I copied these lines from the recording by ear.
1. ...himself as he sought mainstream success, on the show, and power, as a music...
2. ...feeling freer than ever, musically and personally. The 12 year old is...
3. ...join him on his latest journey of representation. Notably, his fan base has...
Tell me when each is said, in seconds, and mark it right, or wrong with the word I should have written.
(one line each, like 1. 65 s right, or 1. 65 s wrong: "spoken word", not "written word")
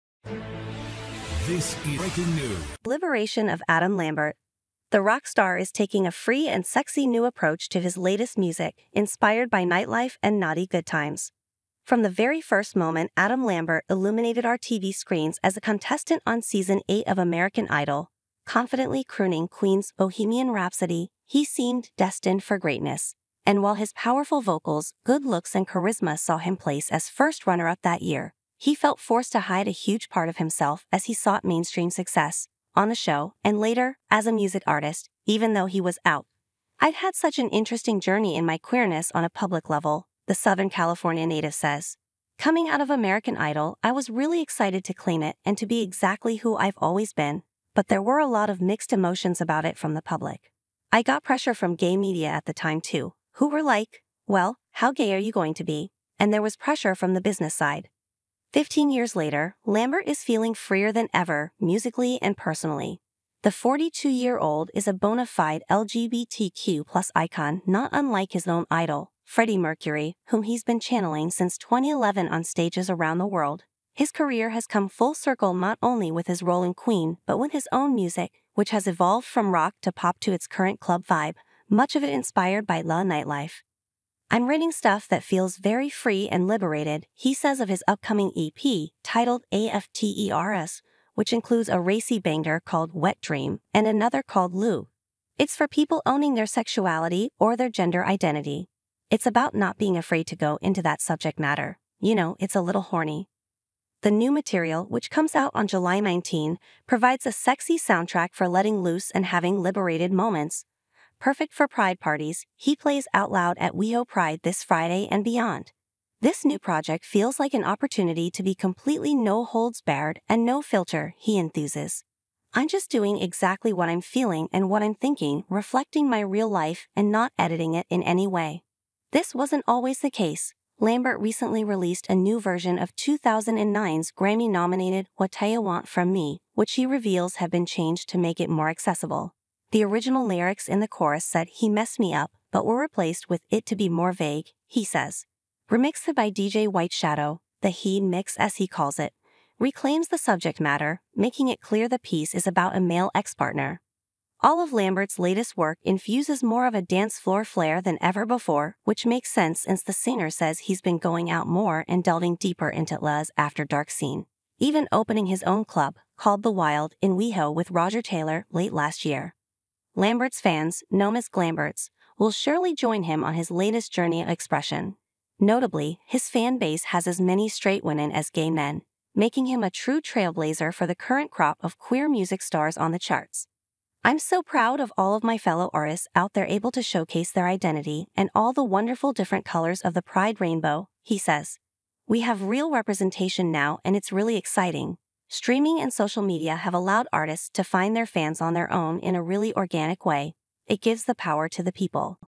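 1. 30 s wrong: "later", not "power"
2. 60 s wrong: "42", not "12"
3. 172 s wrong: "expression", not "representation".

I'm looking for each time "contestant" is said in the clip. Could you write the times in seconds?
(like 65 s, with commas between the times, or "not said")
15 s.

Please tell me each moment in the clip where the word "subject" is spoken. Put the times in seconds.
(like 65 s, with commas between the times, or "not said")
101 s, 150 s.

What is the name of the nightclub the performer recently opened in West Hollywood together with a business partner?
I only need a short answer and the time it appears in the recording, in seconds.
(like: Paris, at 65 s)
The Wild, at 166 s.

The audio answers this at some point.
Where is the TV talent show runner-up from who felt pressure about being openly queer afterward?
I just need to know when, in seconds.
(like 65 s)
40 s.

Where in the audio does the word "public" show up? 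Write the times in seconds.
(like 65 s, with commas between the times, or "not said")
39 s, 50 s.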